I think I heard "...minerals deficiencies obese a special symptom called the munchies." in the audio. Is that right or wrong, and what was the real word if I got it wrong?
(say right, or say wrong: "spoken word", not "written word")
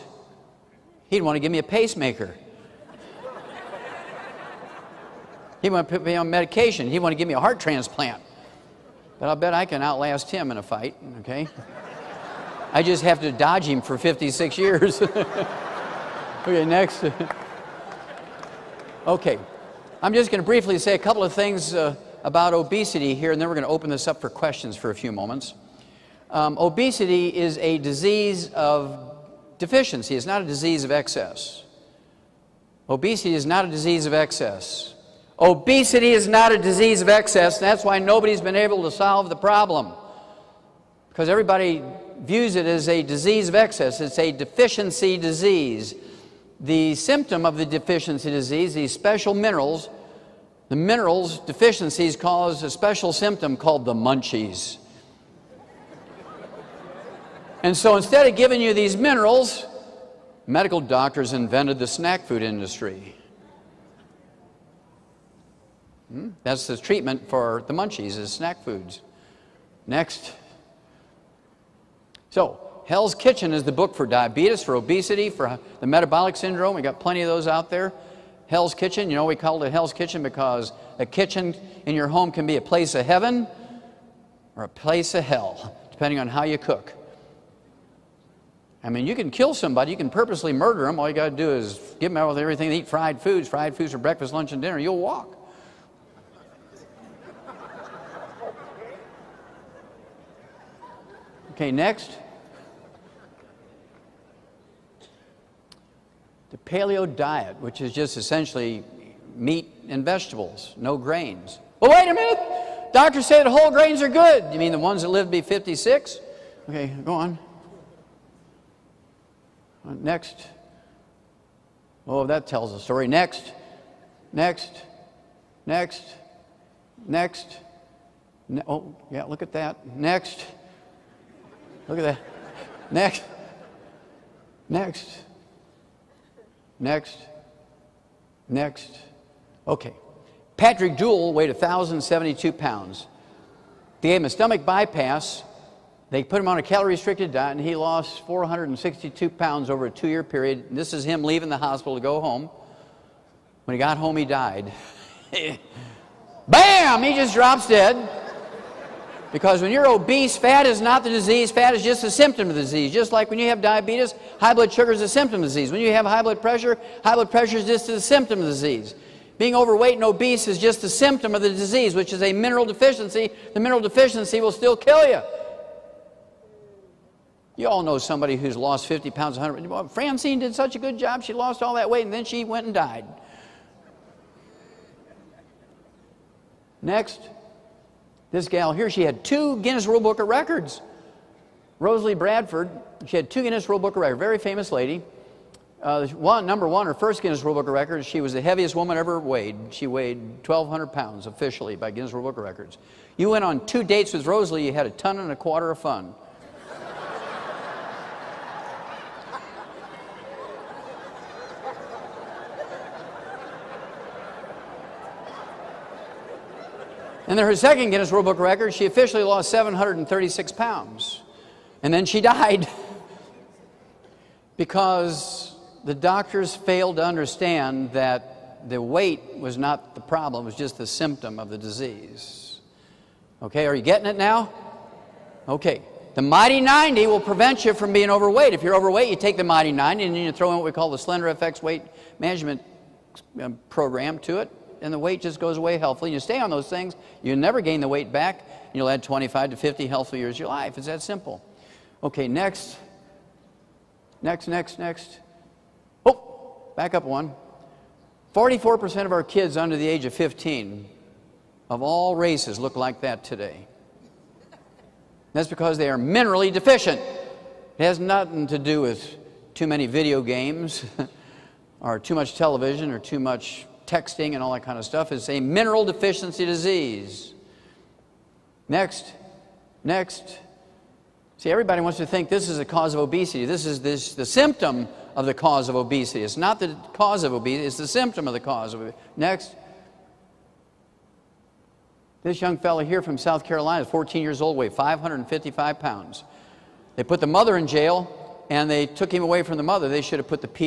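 wrong: "cause", not "obese".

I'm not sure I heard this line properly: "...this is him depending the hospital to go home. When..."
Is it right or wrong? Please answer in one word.
wrong.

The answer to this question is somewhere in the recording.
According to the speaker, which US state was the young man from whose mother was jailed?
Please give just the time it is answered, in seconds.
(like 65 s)
293 s.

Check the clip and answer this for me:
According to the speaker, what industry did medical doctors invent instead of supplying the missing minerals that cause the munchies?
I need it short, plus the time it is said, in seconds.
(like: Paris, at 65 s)
snack food industry, at 61 s.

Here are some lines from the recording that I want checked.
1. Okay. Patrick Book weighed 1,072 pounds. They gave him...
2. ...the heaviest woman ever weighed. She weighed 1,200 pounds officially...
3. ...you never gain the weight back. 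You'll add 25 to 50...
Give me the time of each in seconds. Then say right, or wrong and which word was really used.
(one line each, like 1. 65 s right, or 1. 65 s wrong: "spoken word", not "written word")
1. 139 s wrong: "Deuel", not "Book"
2. 198 s right
3. 247 s right.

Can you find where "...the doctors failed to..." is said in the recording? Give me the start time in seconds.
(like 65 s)
225 s.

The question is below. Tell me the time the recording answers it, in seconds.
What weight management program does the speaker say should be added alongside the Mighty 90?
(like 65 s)
240 s.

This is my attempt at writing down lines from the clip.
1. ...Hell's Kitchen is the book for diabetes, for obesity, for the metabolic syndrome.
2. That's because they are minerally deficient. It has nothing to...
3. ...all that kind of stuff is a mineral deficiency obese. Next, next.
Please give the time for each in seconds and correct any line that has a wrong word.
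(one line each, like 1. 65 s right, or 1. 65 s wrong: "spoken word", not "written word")
1. 72 s right
2. 265 s right
3. 274 s wrong: "disease", not "obese".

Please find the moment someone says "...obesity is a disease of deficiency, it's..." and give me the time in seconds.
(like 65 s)
26 s.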